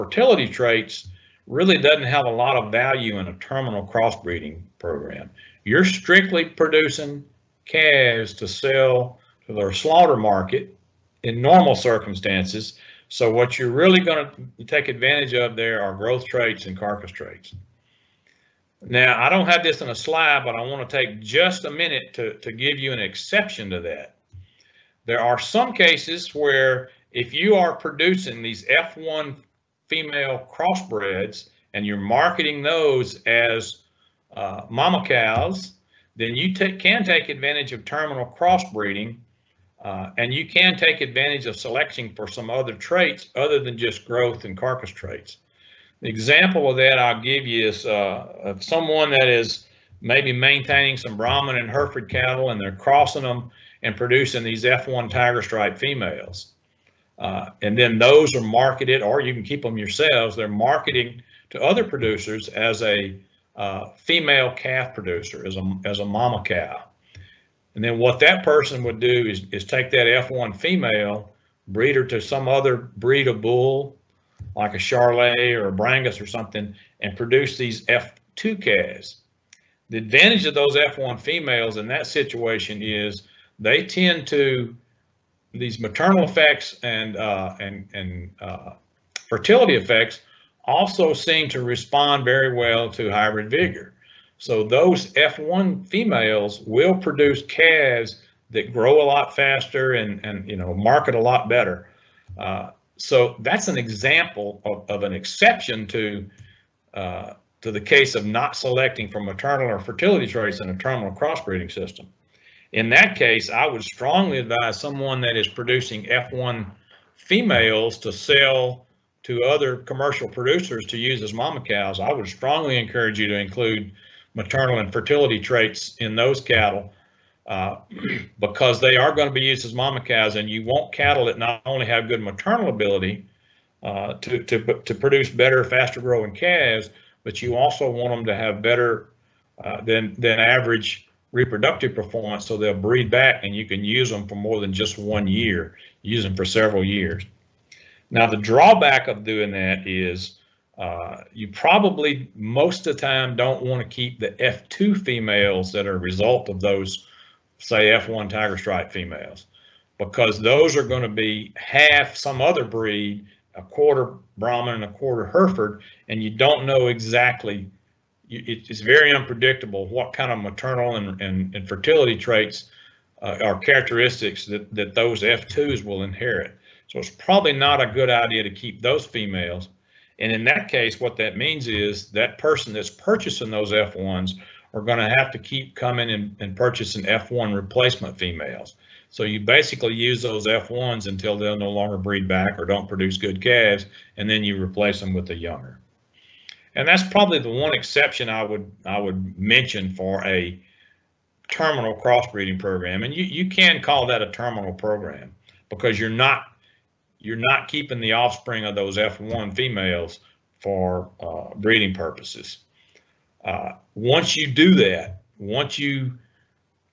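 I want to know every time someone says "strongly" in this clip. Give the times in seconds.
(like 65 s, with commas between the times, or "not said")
113 s, 122 s.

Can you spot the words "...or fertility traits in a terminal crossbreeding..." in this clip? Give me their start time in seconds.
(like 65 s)
109 s.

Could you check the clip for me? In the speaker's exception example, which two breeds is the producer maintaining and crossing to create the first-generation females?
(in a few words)
Brahman and Hereford.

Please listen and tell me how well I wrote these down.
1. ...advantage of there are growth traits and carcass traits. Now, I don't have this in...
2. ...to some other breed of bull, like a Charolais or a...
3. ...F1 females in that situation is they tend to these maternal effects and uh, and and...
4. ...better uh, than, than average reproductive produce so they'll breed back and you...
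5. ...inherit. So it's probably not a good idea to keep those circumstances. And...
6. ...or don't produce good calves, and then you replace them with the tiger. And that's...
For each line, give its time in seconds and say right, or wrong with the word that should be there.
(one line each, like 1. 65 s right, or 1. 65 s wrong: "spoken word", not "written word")
1. 14 s right
2. 72 s right
3. 80 s right
4. 138 s wrong: "performance", not "produce"
5. 176 s wrong: "females", not "circumstances"
6. 192 s wrong: "younger", not "tiger".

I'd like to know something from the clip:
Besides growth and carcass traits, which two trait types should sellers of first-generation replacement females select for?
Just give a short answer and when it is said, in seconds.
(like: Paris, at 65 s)
maternal and fertility, at 124 s.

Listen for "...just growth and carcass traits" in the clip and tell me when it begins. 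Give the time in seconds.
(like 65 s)
43 s.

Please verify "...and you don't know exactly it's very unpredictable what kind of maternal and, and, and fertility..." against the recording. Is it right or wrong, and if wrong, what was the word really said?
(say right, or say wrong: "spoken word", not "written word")
right.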